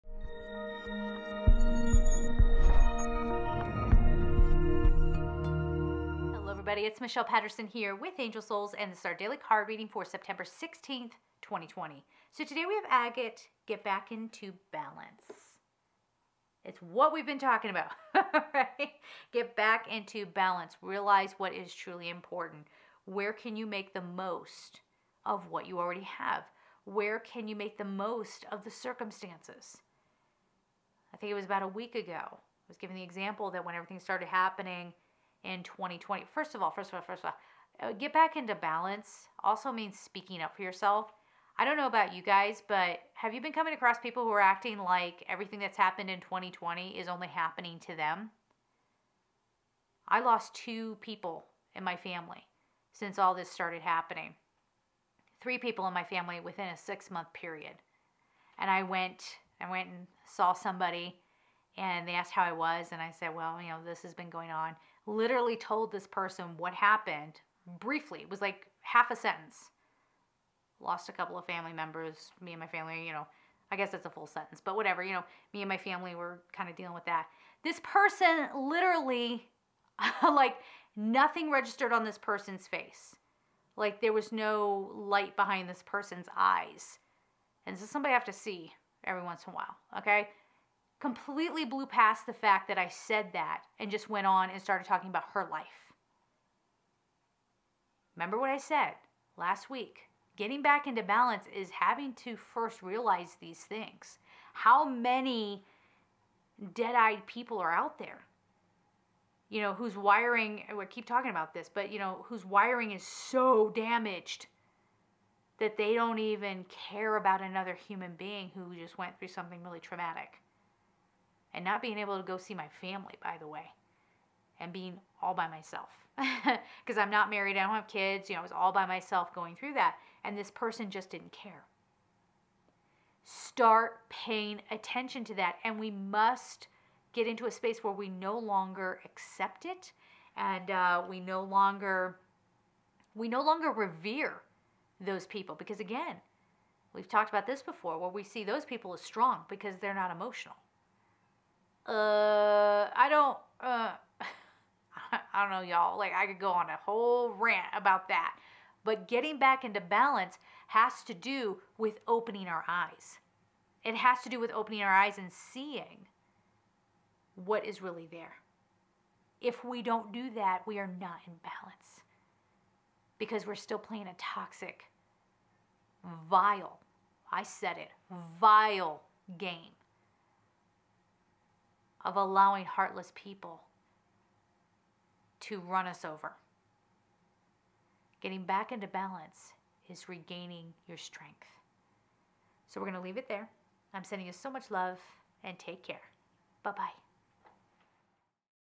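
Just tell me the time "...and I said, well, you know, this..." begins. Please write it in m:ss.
1:02.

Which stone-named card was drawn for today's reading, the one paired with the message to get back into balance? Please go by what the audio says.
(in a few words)
Agate.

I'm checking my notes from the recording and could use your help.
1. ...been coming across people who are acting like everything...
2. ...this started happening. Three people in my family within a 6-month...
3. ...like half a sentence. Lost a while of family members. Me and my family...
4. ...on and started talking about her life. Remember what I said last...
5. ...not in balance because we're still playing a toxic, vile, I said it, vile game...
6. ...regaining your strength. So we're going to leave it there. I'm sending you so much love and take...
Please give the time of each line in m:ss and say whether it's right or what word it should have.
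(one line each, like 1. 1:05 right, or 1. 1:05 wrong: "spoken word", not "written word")
1. 0:43 right
2. 0:53 right
3. 1:08 wrong: "couple", not "while"
4. 1:34 right
5. 2:50 right
6. 3:10 right.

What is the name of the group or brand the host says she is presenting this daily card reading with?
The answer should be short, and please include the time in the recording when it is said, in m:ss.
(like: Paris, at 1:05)
Angel Souls, at 0:08.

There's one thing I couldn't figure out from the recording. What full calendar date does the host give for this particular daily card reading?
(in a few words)
September 16, 2020.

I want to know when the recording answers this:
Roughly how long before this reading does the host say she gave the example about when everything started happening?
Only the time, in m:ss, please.
0:31.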